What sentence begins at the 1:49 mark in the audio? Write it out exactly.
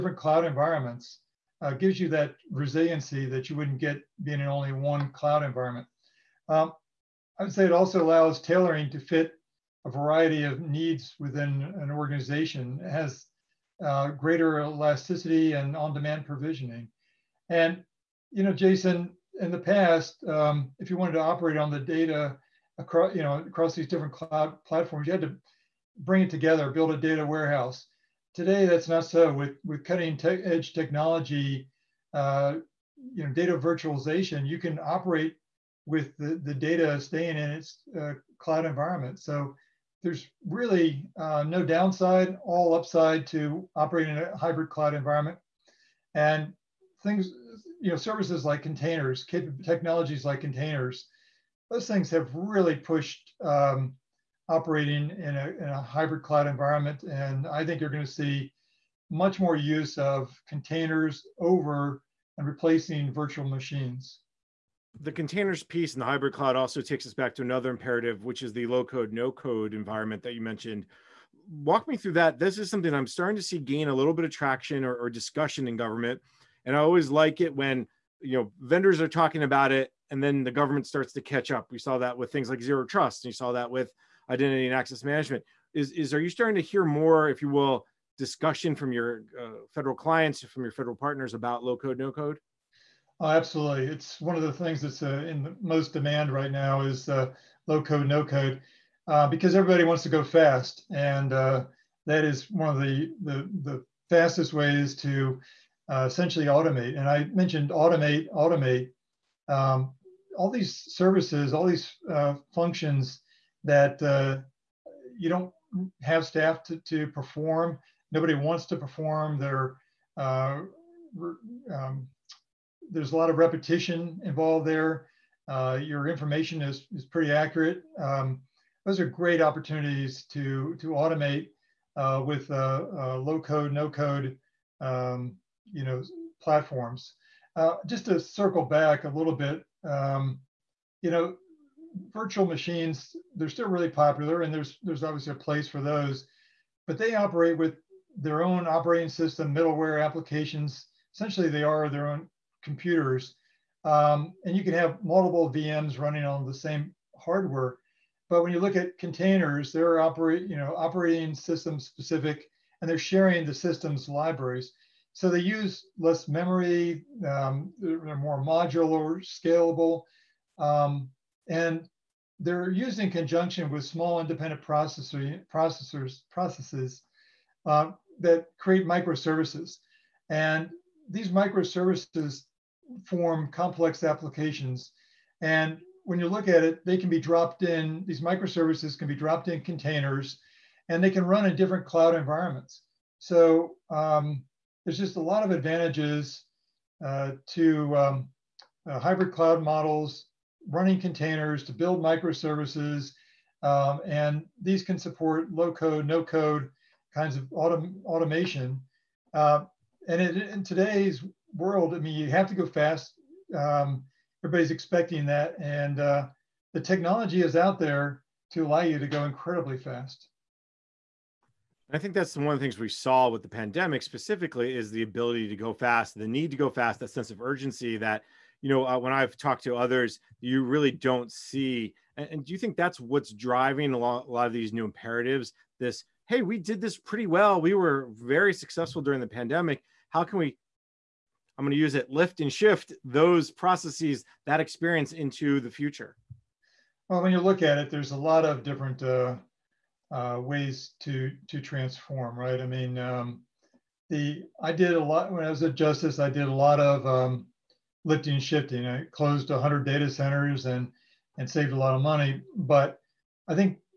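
Um, all these services, all these uh, functions that you don't have staff to, to perform, nobody wants to perform.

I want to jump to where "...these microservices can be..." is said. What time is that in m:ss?
3:08.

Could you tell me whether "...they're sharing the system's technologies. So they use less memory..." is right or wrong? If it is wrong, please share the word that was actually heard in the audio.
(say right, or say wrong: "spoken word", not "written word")
wrong: "libraries", not "technologies".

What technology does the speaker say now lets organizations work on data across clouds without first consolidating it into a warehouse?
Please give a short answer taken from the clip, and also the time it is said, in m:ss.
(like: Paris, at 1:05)
data virtualization, at 0:33.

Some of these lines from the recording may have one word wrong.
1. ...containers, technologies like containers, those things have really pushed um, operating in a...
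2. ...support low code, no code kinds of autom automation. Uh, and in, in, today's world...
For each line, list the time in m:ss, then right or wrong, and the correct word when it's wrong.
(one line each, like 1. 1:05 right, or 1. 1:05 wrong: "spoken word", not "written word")
1. 0:48 right
2. 3:24 right.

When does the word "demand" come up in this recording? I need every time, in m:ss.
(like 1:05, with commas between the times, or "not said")
0:15, 1:35.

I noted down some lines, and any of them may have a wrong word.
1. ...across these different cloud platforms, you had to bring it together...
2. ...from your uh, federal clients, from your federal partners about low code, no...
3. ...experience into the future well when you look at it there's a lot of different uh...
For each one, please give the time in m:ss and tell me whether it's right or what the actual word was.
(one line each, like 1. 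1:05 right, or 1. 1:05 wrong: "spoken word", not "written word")
1. 0:23 right
2. 1:28 right
3. 4:04 right.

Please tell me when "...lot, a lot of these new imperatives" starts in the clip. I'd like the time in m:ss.
3:53.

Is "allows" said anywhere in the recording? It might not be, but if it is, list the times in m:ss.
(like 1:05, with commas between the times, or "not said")
0:08, 3:38.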